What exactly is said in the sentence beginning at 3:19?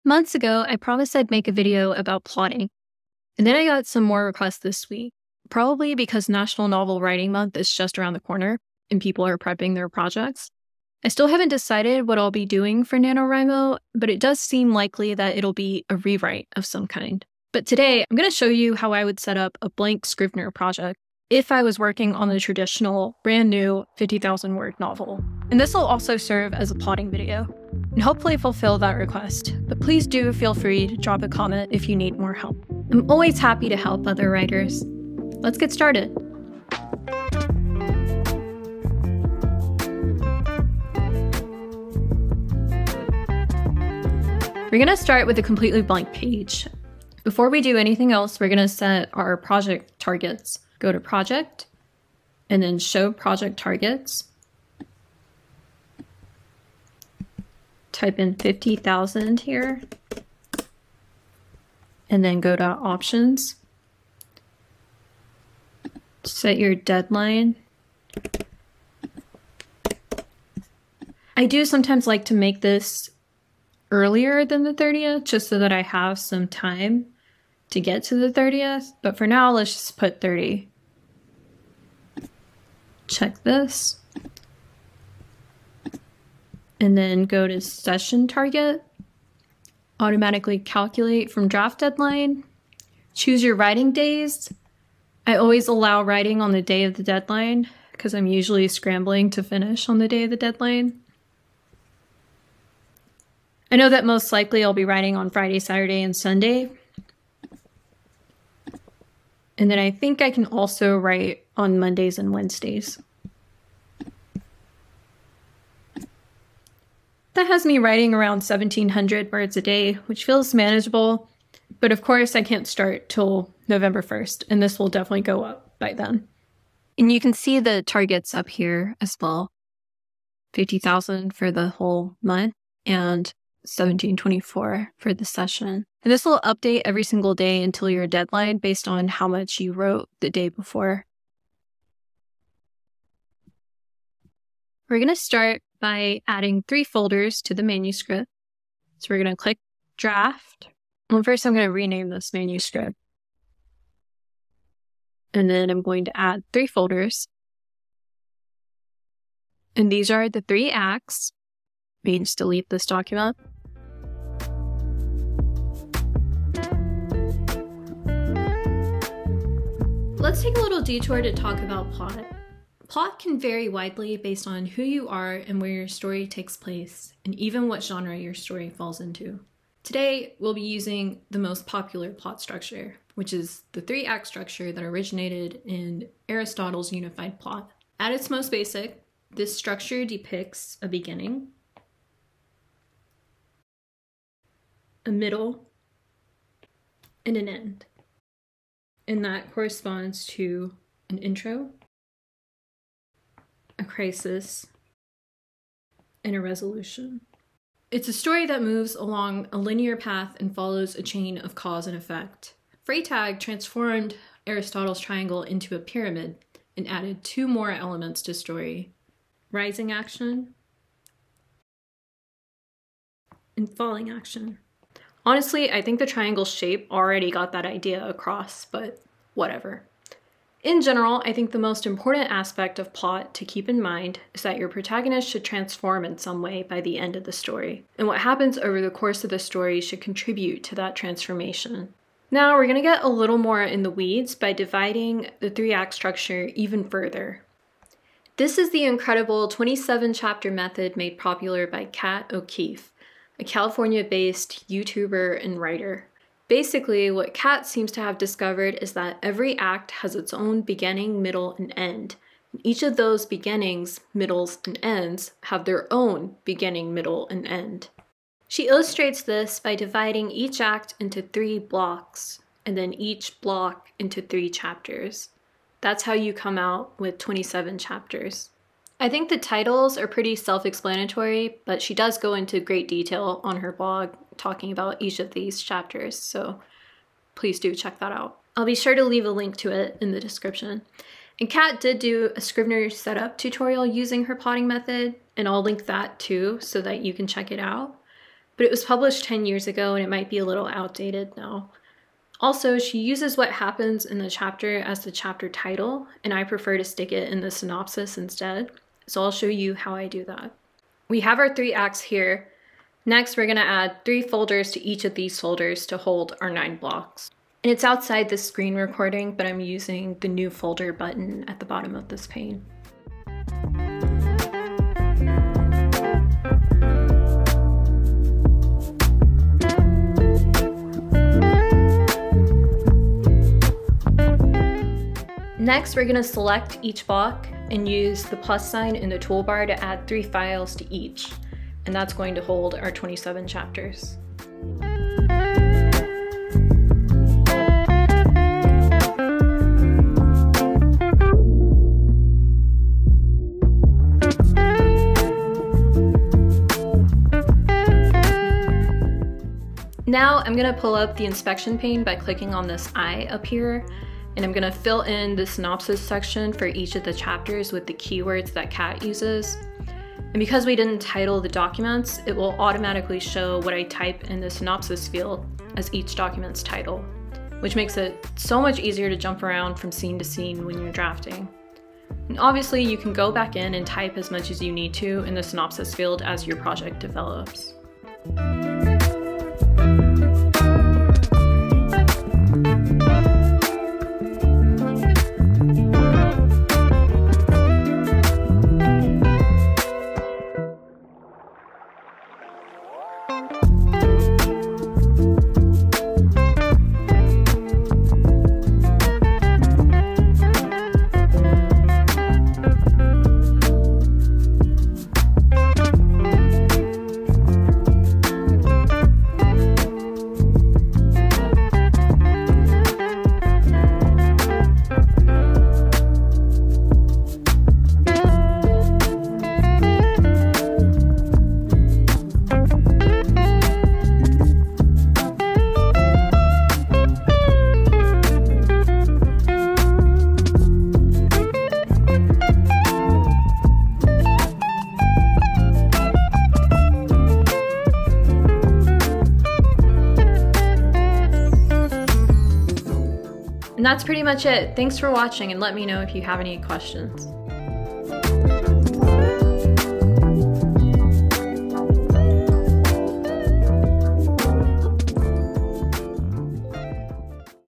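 And that corresponds to an intro, a crisis, and a resolution.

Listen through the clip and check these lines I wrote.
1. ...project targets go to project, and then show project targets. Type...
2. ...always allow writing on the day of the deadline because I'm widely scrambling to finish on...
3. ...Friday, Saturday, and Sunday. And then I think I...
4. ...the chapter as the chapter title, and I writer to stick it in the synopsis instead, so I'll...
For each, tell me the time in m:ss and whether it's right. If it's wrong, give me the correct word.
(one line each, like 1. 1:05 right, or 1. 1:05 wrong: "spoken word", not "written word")
1. 0:49 right
2. 1:35 wrong: "usually", not "widely"
3. 1:45 right
4. 5:04 wrong: "prefer", not "writer".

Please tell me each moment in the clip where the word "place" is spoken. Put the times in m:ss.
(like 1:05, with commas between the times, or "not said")
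2:56.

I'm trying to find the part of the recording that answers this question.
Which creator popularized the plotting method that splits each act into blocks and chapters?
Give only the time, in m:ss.
4:11.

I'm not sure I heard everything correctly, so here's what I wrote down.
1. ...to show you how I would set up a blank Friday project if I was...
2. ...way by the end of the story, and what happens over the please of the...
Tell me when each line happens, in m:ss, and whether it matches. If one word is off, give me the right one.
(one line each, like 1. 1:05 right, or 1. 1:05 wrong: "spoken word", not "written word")
1. 0:18 wrong: "Scrivener", not "Friday"
2. 3:56 wrong: "course", not "please".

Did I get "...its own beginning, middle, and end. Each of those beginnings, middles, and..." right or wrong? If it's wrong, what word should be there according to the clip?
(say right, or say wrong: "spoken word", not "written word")
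right.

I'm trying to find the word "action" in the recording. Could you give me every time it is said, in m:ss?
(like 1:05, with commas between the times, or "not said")
3:39, 3:44.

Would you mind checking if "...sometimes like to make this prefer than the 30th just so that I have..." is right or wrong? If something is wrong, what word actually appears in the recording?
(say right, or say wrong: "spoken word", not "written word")
wrong: "earlier", not "prefer".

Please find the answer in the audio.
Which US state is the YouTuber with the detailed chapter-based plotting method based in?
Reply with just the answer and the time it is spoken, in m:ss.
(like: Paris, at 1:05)
California, at 4:13.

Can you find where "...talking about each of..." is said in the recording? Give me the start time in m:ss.
4:44.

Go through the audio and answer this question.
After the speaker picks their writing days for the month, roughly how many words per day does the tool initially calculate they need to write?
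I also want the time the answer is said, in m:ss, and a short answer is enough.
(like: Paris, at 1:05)
1700, at 1:58.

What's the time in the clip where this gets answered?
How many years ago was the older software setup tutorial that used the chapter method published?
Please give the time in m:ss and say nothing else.
4:59.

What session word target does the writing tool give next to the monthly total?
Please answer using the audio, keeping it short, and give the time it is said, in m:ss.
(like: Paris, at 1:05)
1724, at 2:13.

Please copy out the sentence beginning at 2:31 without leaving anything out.
Well, first I'm going to rename this manuscript.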